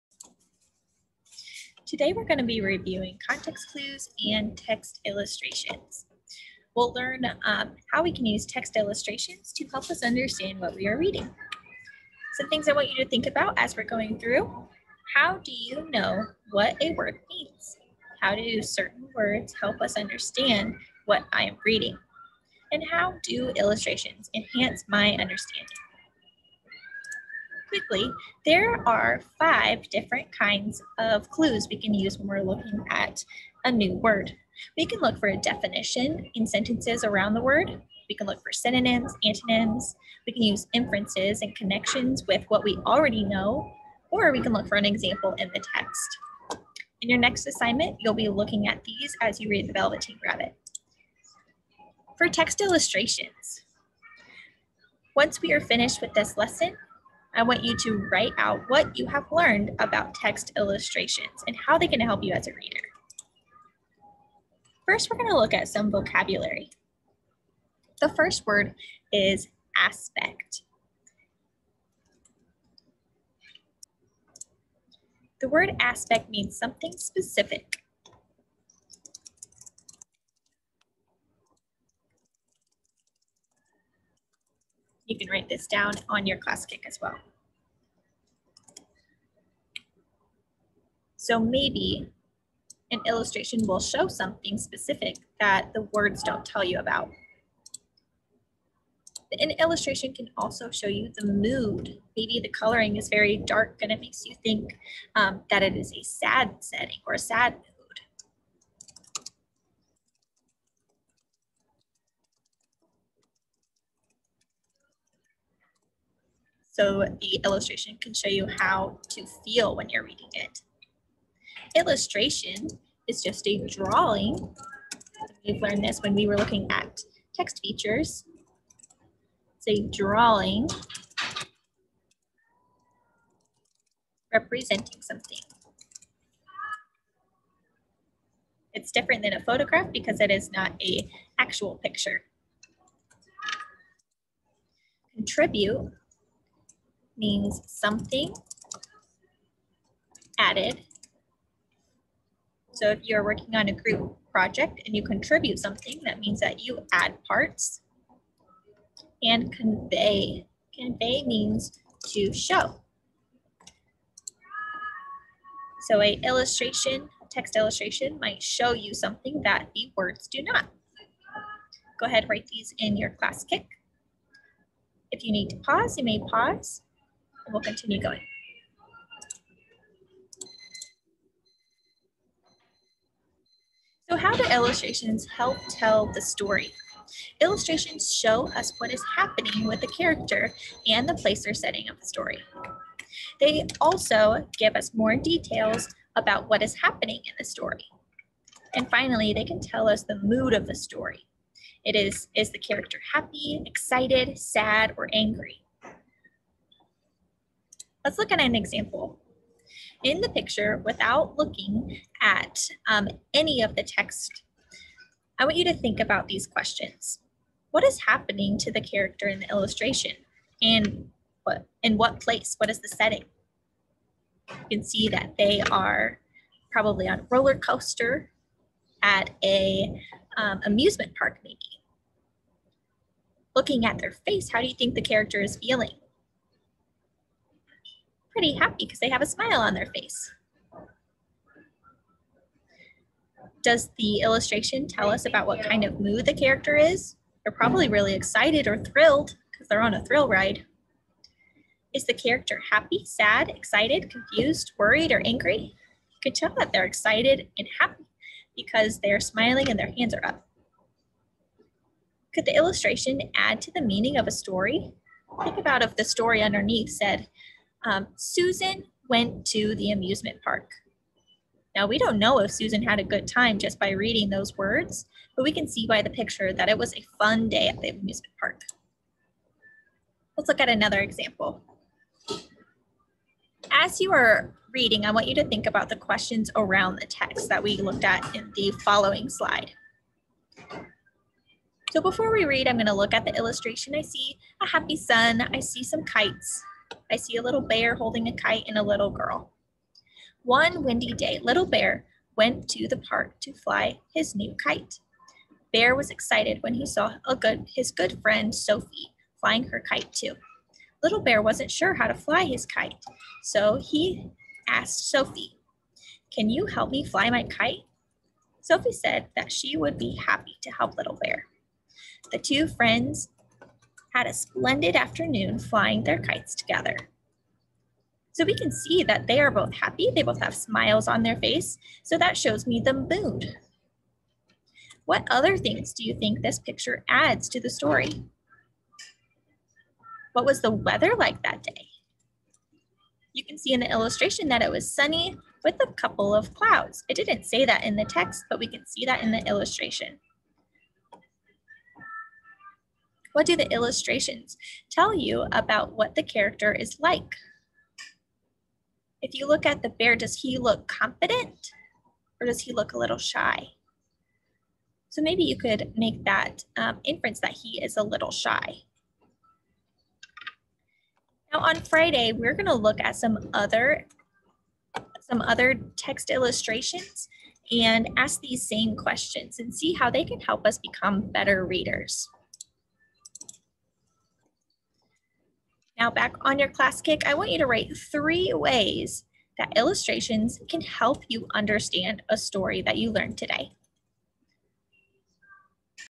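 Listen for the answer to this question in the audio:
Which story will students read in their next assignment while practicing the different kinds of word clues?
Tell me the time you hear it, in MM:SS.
00:49.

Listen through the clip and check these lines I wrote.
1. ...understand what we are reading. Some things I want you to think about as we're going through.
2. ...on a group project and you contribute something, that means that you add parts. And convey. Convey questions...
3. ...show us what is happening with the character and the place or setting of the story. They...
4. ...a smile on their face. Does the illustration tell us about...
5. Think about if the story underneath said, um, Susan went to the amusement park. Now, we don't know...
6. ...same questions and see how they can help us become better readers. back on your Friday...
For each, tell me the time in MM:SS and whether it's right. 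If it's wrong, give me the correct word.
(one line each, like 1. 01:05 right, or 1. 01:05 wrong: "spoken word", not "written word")
1. 00:10 right
2. 02:33 wrong: "means", not "questions"
3. 03:08 right
4. 03:59 right
5. 04:25 right
6. 06:18 wrong: "Classkick", not "Friday".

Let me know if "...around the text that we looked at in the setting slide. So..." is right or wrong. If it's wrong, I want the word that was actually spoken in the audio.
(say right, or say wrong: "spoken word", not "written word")
wrong: "following", not "setting".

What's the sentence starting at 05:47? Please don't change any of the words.
It didn't say that in the text, but we can see that in the illustration.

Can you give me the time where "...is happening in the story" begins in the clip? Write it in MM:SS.
03:16.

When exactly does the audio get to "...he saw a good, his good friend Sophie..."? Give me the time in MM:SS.
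05:06.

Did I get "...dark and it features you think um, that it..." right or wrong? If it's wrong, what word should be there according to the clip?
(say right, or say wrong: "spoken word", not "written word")
wrong: "makes", not "features".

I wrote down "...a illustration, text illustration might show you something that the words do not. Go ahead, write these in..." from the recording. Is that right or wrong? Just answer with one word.
right.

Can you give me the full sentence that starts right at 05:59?
If you look at the bear, does he look confident or does he look a little shy?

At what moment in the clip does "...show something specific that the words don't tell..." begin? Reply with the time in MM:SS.
01:33.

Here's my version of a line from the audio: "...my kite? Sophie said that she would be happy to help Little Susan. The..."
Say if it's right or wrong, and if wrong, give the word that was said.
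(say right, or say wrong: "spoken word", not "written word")
wrong: "Bear", not "Susan".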